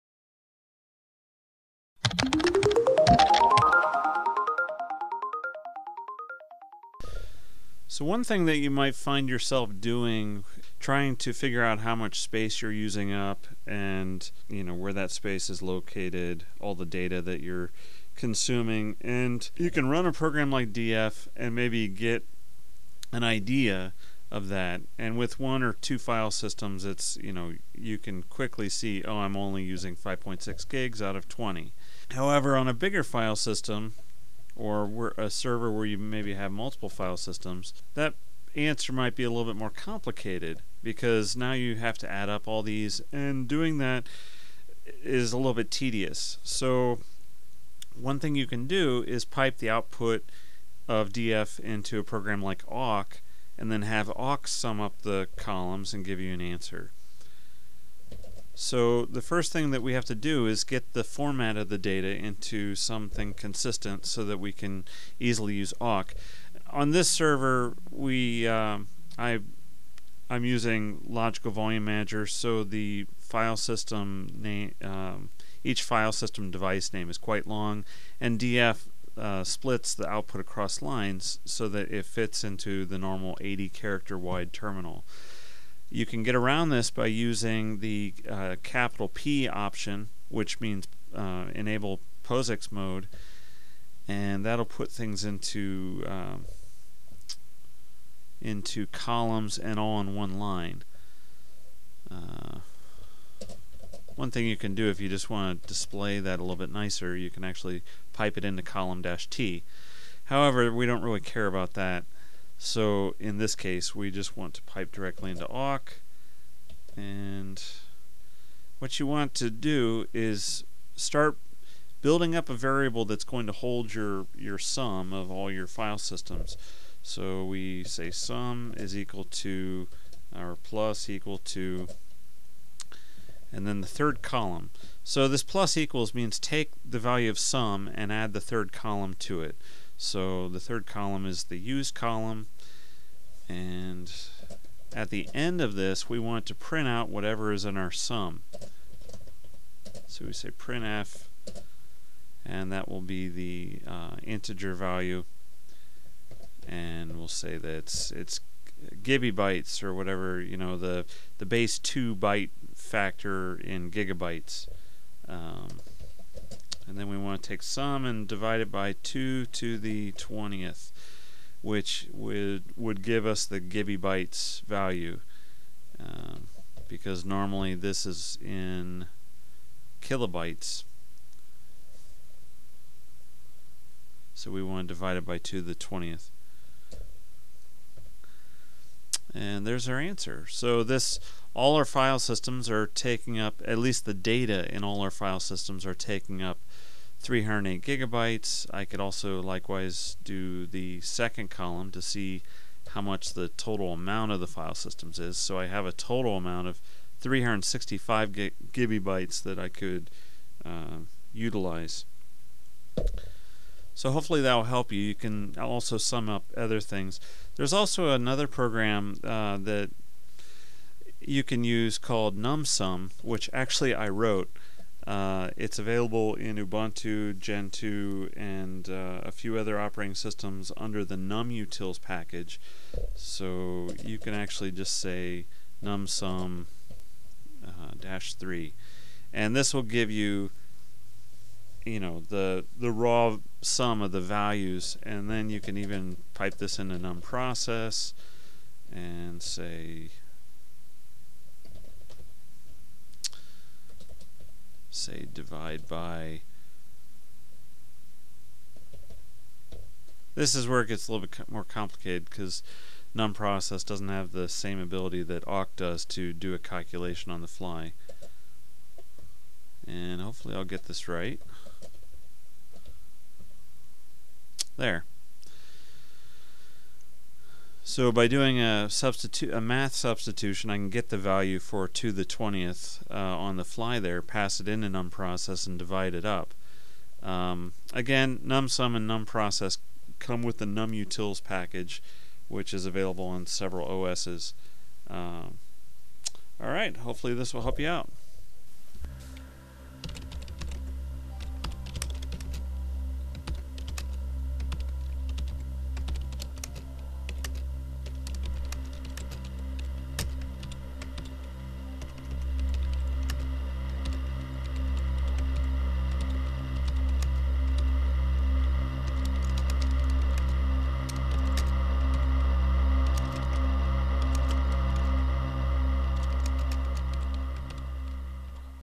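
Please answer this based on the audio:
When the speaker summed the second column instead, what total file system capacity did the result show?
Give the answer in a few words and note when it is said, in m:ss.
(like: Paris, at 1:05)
365 gigabytes, at 3:27.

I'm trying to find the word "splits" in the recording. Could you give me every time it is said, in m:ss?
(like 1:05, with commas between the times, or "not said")
1:19.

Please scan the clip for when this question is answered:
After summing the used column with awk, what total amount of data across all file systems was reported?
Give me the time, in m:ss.
3:17.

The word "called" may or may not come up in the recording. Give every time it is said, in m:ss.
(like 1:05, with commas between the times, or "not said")
3:41.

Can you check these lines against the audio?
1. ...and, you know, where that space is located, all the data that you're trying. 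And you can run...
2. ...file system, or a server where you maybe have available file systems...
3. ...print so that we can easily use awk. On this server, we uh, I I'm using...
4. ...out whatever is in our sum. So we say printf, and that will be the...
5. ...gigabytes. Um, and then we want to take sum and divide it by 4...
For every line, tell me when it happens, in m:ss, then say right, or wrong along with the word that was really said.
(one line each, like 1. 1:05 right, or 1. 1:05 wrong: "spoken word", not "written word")
1. 0:13 wrong: "consuming", not "trying"
2. 0:33 wrong: "multiple", not "available"
3. 1:03 wrong: "consistent", not "print"
4. 2:26 right
5. 2:43 wrong: "2", not "4".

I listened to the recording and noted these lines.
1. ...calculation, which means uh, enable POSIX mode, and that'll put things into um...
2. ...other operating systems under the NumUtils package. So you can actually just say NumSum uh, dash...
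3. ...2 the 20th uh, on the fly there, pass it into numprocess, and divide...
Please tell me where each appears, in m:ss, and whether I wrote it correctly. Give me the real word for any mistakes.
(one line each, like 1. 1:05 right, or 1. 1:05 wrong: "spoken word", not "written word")
1. 1:29 wrong: "option", not "calculation"
2. 3:49 right
3. 4:41 right.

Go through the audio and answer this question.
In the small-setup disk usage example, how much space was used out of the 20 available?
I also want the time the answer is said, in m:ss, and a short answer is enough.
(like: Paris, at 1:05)
5.6 gigs, at 0:29.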